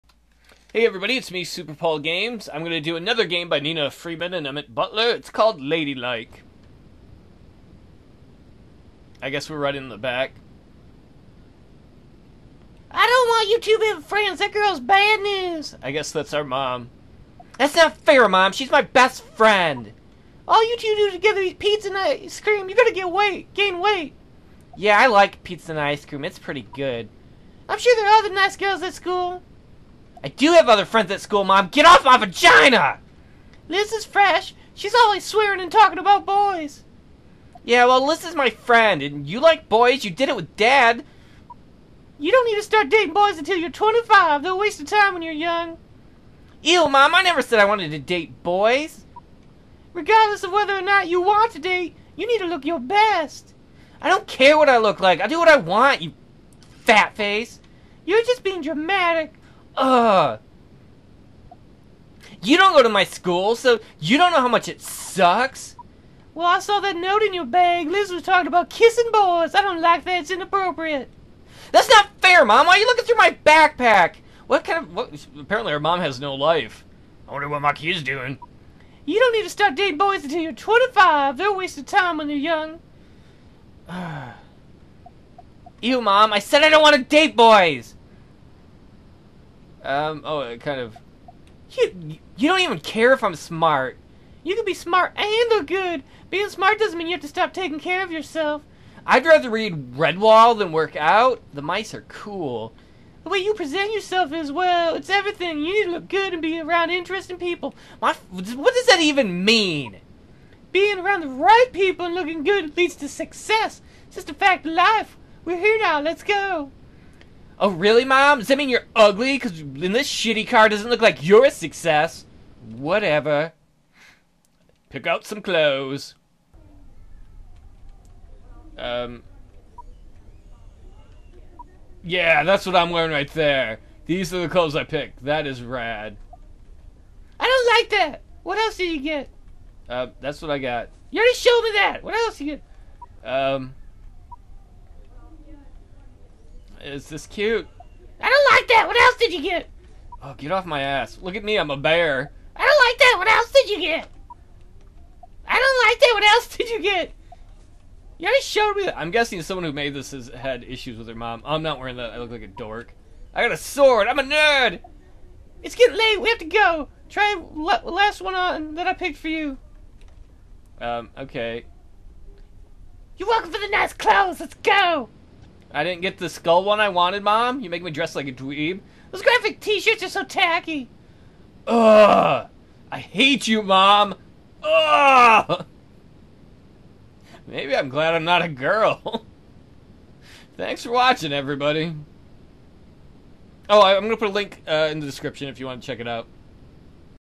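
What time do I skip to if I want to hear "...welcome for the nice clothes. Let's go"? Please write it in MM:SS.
02:53.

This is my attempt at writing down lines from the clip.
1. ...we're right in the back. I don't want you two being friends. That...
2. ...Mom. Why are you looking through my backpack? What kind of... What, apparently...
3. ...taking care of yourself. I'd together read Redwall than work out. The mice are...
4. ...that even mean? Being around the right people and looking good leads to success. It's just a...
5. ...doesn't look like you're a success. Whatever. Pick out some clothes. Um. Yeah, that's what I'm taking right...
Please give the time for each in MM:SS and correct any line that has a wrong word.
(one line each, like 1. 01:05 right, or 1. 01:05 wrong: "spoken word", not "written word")
1. 00:09 right
2. 01:12 right
3. 01:37 wrong: "rather", not "together"
4. 01:48 right
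5. 02:00 wrong: "wearing", not "taking".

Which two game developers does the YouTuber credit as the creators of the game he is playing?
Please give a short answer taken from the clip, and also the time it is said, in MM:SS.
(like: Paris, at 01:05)
Nina Freeman and Emmett Butler, at 00:03.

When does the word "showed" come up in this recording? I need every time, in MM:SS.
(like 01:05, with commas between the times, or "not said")
02:21, 02:38.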